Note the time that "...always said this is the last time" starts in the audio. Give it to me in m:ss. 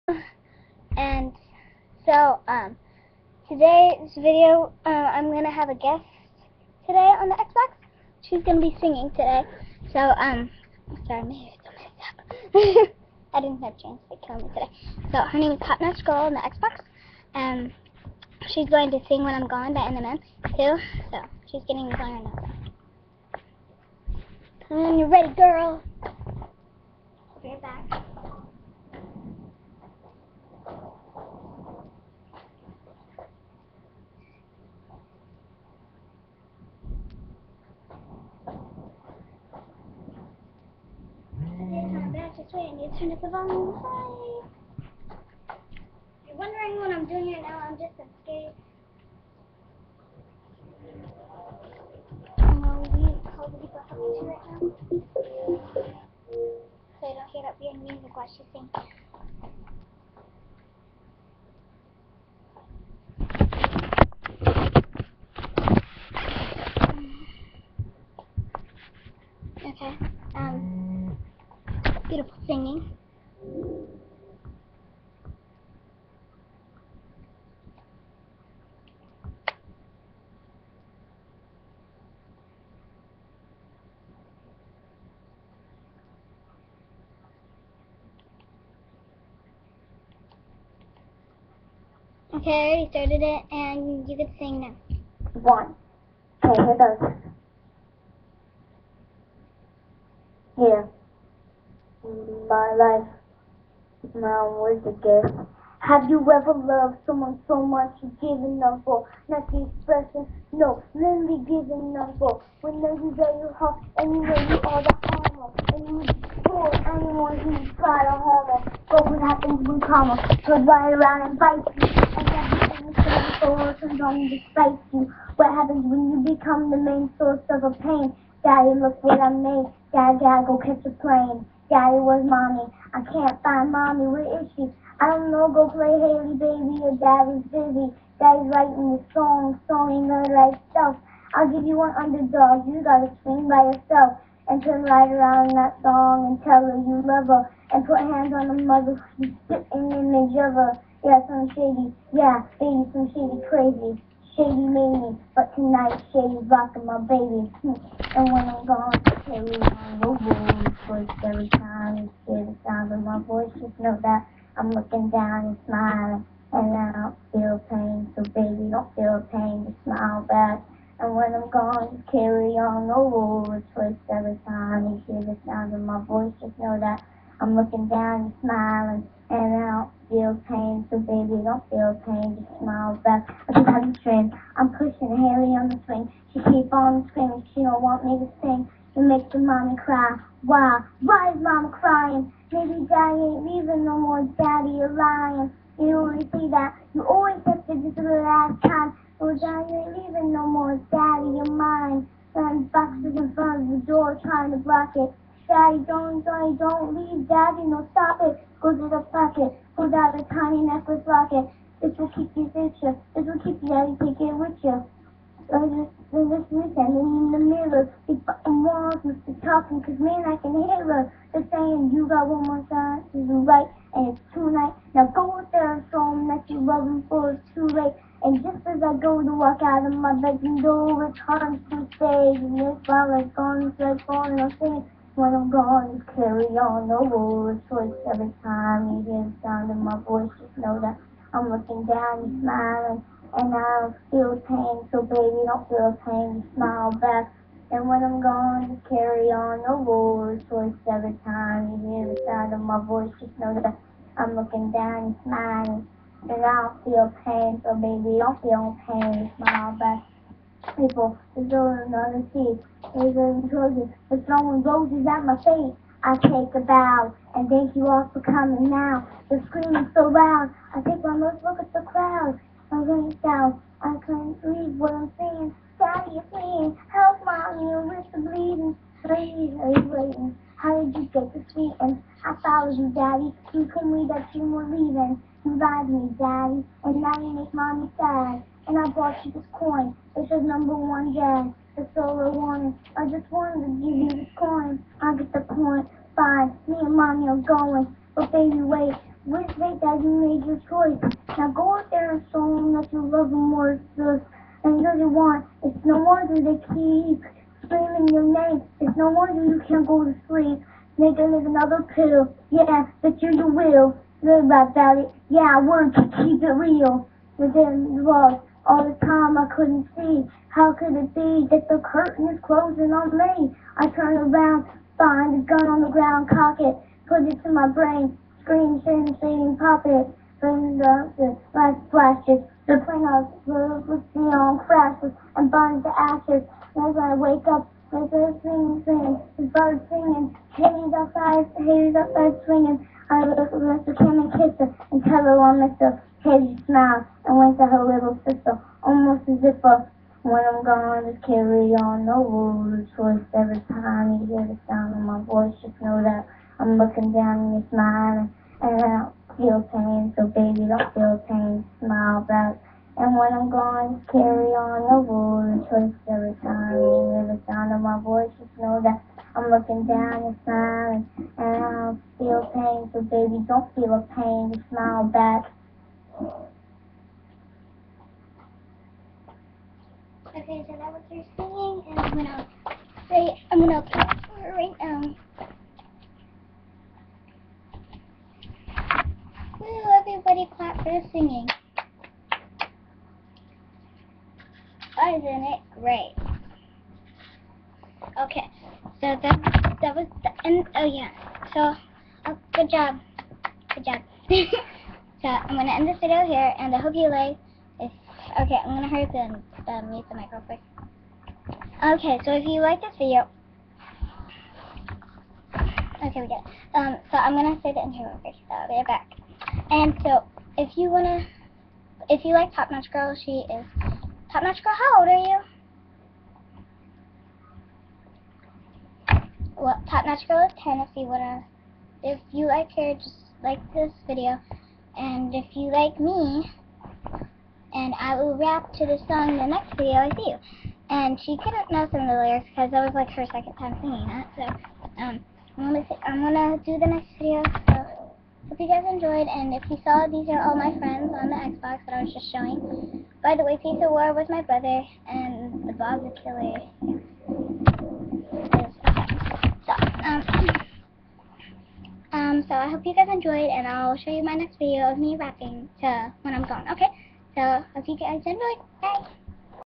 3:17.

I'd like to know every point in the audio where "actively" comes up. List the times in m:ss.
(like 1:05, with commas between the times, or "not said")
not said.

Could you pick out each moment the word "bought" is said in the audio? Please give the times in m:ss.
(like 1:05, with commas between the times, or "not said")
4:48.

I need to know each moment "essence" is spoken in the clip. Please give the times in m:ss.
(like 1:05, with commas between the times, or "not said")
not said.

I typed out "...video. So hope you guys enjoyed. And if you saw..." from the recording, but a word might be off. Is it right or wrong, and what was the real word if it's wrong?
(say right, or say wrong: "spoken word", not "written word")
right.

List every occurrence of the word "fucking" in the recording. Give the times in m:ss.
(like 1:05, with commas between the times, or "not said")
3:38.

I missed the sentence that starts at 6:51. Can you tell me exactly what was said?
Okay, so if you like this video, okay, we get.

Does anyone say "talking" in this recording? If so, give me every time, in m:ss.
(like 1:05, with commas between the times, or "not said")
0:53, 3:39.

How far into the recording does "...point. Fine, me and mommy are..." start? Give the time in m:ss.
4:55.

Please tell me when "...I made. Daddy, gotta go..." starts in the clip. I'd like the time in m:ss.
2:09.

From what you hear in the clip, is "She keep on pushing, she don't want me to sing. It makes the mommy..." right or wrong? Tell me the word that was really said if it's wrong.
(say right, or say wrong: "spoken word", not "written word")
wrong: "screaming", not "pushing".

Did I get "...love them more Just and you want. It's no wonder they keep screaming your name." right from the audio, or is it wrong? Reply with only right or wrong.
right.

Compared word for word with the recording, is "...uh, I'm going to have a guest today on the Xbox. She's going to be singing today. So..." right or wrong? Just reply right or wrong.
right.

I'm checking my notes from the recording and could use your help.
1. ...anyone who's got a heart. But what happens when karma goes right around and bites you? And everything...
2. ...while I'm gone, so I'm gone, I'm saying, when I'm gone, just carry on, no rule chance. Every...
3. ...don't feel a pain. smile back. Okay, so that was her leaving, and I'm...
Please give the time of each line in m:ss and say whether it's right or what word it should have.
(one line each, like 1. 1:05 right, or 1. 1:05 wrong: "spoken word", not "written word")
1. 1:56 right
2. 3:52 wrong: "choice", not "chance"
3. 6:13 wrong: "singing", not "leaving".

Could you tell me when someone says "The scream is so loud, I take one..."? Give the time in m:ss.
4:29.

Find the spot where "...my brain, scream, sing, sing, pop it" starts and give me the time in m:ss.
5:27.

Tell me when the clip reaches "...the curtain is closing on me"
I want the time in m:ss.
5:21.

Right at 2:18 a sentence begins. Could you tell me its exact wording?
Daddy's writing the song, song ain't gonna write stuff.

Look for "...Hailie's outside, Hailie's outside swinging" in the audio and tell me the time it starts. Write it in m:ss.
5:40.